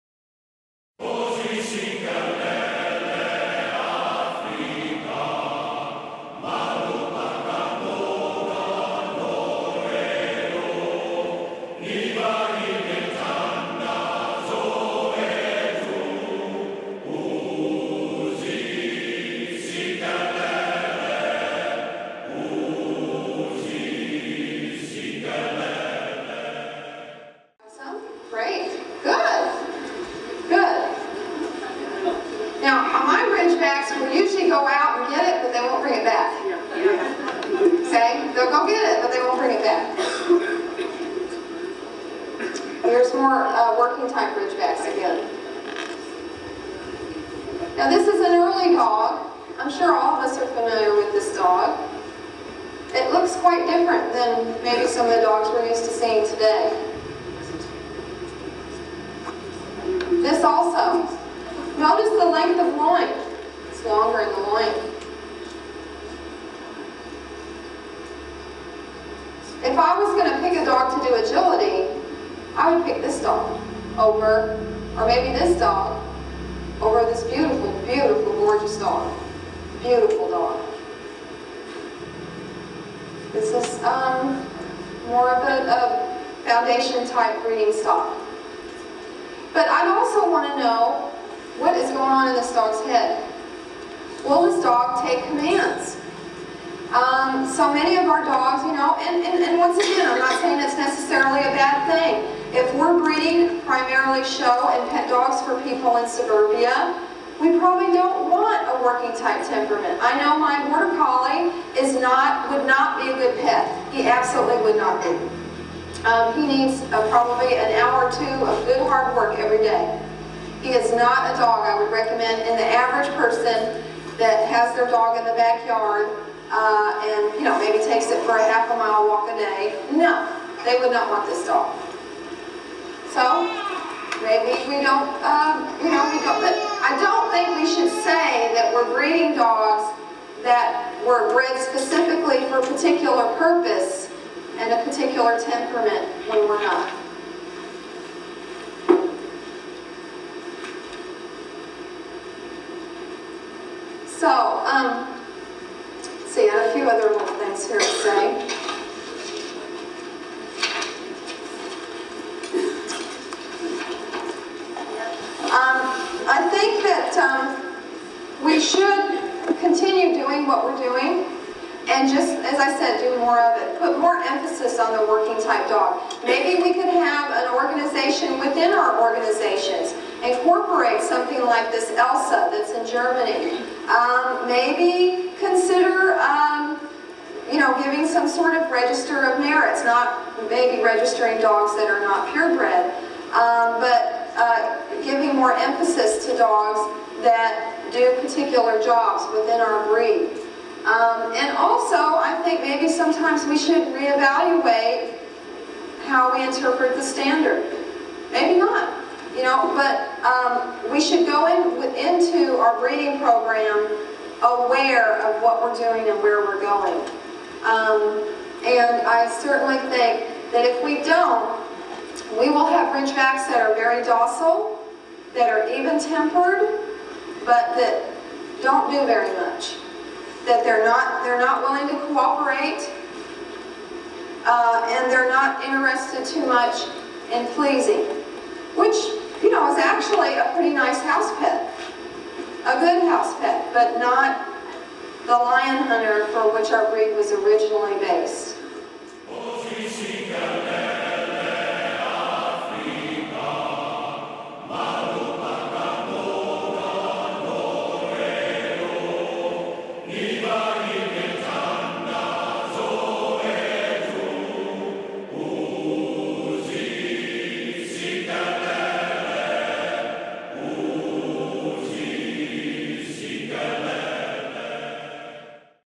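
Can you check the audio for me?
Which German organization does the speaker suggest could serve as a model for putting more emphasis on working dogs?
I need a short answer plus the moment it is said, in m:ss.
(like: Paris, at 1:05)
ELSA, at 3:01.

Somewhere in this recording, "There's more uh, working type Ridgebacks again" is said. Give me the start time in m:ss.
0:42.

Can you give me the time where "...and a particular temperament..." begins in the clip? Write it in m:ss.
2:24.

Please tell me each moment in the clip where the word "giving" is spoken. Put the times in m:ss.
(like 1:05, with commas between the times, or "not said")
3:07, 3:15.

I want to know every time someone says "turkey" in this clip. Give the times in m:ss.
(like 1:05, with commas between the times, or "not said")
not said.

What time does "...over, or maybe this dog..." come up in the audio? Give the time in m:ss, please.
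1:13.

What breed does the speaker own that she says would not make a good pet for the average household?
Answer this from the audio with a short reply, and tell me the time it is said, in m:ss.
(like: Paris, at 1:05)
border collie, at 1:50.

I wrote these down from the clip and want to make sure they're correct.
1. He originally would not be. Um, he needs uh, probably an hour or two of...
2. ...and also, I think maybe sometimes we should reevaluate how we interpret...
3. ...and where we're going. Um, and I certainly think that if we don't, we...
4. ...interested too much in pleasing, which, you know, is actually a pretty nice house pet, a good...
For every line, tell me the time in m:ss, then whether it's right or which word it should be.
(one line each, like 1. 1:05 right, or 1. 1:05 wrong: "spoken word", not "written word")
1. 1:53 wrong: "absolutely", not "originally"
2. 3:21 right
3. 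3:36 right
4. 3:55 right.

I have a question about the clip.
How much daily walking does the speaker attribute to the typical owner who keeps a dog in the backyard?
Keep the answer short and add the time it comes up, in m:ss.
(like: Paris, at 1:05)
half a mile, at 2:08.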